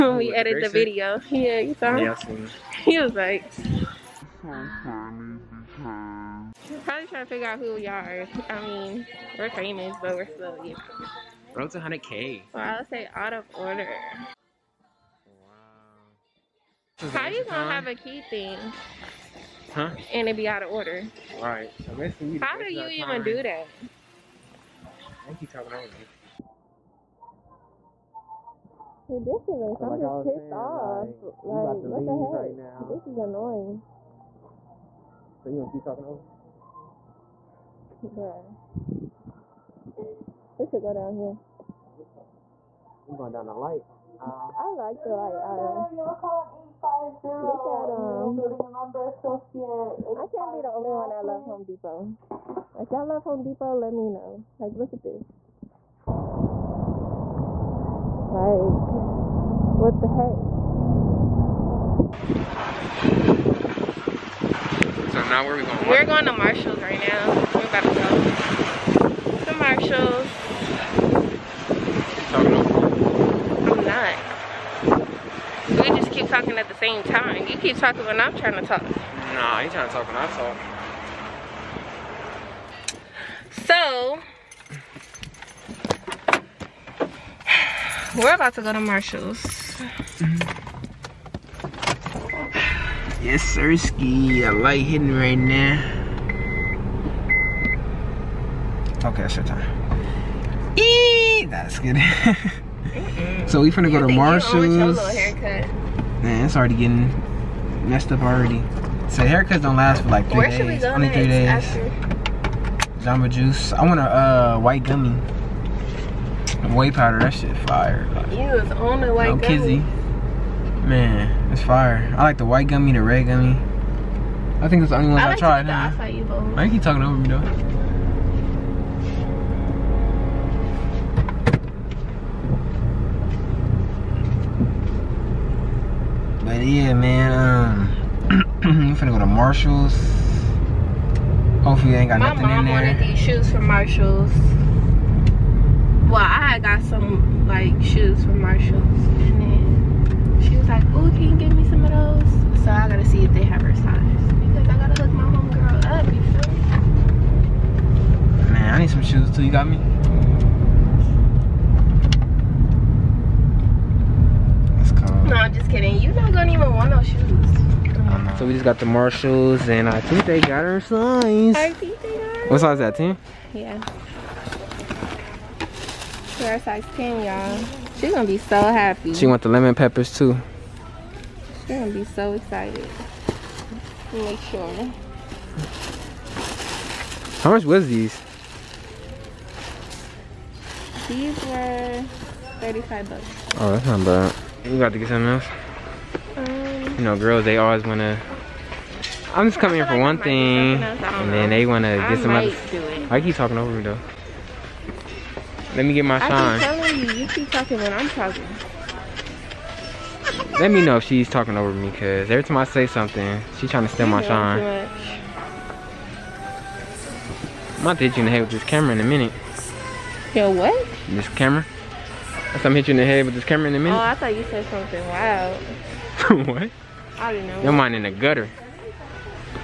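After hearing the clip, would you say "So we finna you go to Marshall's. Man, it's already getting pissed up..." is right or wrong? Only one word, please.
wrong.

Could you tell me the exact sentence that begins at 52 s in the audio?
If y'all love Home Depot, let me know.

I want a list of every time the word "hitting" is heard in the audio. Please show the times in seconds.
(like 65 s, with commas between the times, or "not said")
94 s.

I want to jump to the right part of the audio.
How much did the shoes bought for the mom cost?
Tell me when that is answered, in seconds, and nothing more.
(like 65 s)
192 s.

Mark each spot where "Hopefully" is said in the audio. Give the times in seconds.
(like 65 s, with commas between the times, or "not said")
141 s.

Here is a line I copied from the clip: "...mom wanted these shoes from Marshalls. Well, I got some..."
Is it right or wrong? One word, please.
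right.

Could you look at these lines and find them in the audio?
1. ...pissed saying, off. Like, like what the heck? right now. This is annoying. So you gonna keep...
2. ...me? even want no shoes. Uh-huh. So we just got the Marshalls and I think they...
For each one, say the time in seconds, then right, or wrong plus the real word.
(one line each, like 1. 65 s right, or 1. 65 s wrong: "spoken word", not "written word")
1. 30 s right
2. 159 s right.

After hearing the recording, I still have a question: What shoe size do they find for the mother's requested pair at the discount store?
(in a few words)
10.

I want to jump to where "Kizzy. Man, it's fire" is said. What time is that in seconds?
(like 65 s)
119 s.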